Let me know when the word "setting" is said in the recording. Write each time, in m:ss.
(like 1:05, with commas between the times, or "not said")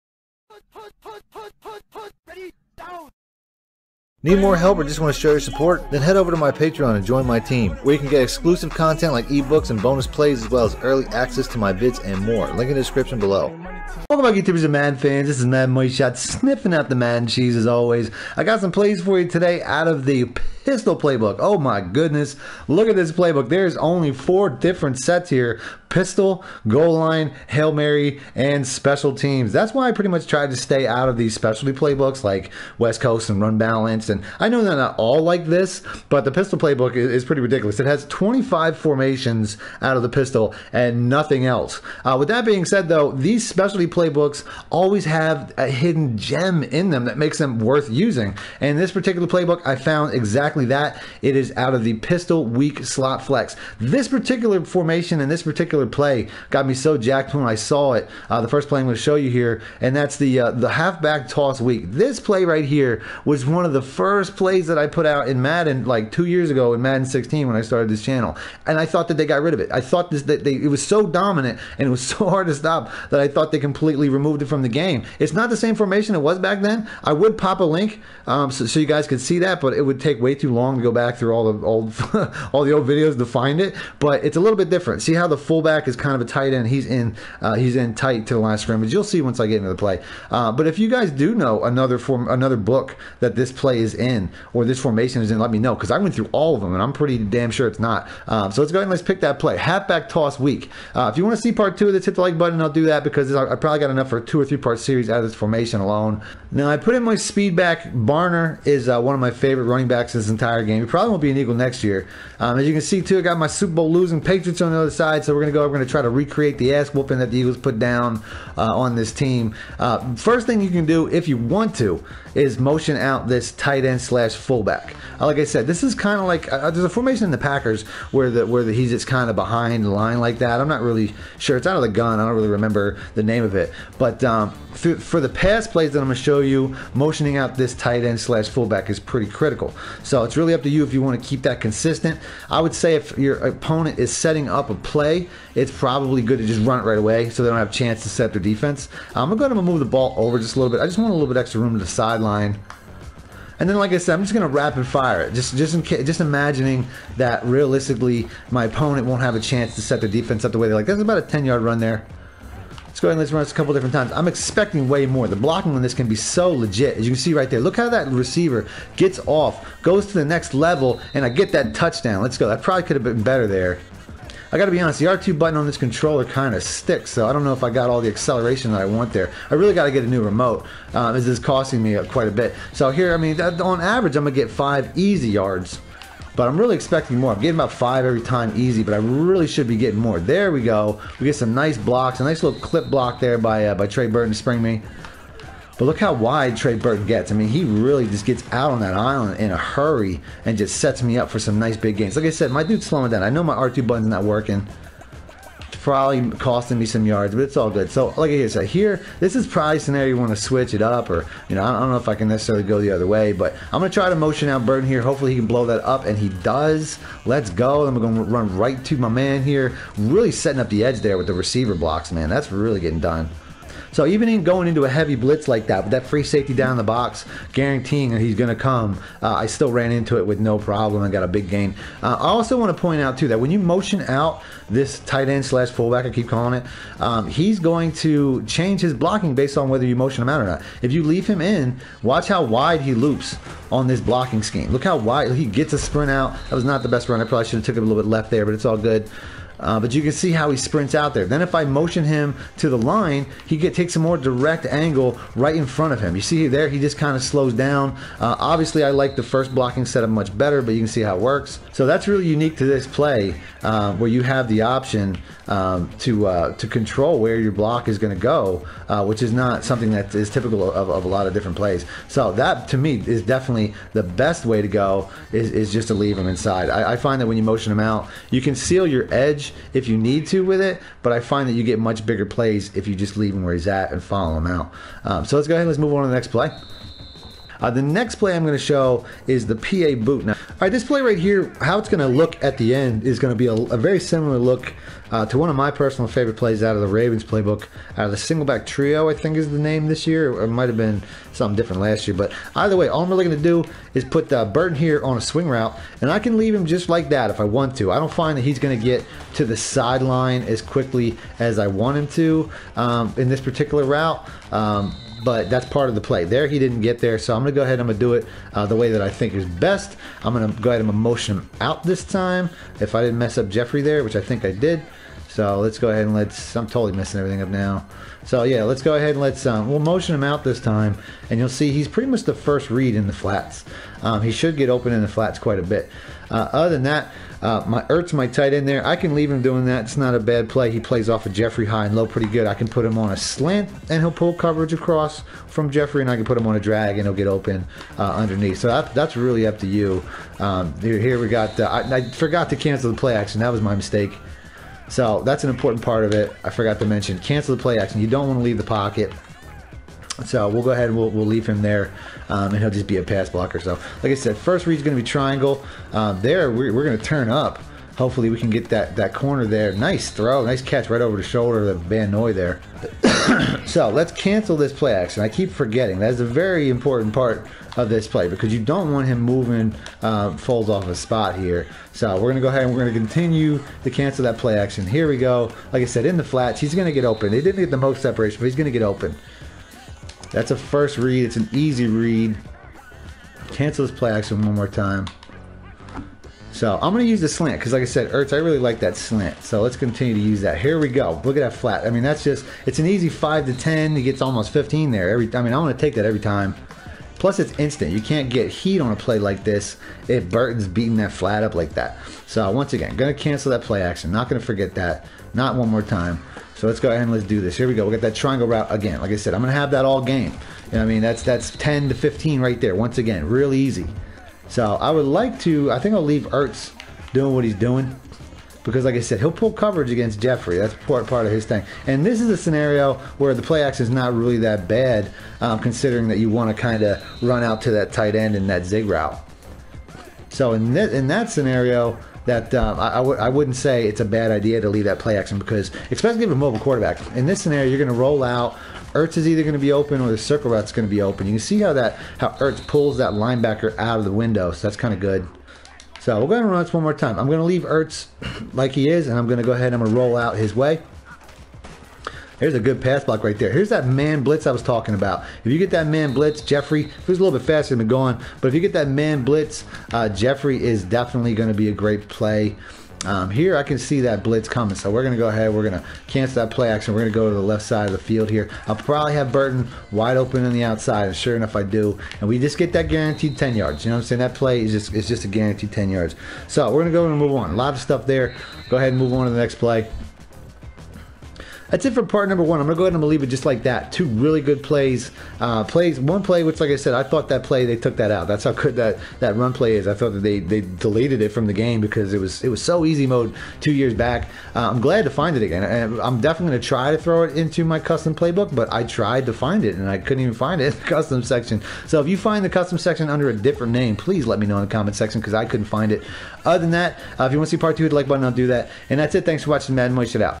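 2:24, 3:40.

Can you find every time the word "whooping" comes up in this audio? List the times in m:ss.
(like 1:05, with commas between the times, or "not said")
1:56.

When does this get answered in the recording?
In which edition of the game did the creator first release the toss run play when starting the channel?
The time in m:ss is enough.
1:06.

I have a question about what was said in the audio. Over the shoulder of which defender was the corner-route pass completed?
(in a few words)
Van Noy.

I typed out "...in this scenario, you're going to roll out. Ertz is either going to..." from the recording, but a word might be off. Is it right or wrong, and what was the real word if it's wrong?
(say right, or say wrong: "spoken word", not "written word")
right.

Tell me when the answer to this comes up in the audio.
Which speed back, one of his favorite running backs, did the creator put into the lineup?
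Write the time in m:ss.
1:47.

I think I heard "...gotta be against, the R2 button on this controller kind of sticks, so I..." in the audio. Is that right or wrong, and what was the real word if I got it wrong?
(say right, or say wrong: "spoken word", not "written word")
wrong: "honest", not "against".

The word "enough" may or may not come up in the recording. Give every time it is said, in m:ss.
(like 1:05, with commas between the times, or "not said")
1:43, 8:01.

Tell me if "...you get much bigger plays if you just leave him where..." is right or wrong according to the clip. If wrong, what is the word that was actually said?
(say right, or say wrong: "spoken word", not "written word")
right.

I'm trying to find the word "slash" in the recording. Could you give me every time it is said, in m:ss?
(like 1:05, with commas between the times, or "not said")
2:04, 2:18, 3:55.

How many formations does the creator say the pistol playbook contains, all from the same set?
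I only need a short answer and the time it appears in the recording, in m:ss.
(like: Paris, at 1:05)
25, at 0:38.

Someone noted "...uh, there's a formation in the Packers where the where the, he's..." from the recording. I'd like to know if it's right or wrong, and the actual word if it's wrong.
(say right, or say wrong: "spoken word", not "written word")
right.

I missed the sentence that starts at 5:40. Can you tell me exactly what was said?
He plays off of Jeffery high and low pretty good.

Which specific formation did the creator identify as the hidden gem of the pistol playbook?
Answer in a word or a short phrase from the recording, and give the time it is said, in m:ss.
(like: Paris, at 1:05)
Pistol weak slot flex, at 0:51.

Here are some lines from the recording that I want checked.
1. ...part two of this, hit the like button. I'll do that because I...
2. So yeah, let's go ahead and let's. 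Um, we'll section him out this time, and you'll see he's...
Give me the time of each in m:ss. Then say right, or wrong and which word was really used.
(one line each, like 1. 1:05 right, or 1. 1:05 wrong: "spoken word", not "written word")
1. 1:41 right
2. 5:28 wrong: "motion", not "section".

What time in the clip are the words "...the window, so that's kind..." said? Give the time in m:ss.
7:34.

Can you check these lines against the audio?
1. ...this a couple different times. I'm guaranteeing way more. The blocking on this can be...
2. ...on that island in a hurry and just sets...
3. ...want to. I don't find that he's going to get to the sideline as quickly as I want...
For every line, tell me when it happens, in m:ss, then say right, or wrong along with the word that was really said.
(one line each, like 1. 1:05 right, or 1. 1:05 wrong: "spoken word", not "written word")
1. 2:43 wrong: "expecting", not "guaranteeing"
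2. 3:18 right
3. 5:07 right.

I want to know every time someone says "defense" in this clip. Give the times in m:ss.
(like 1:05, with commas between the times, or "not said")
2:28, 2:40.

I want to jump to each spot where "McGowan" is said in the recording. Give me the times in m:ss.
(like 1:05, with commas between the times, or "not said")
7:47.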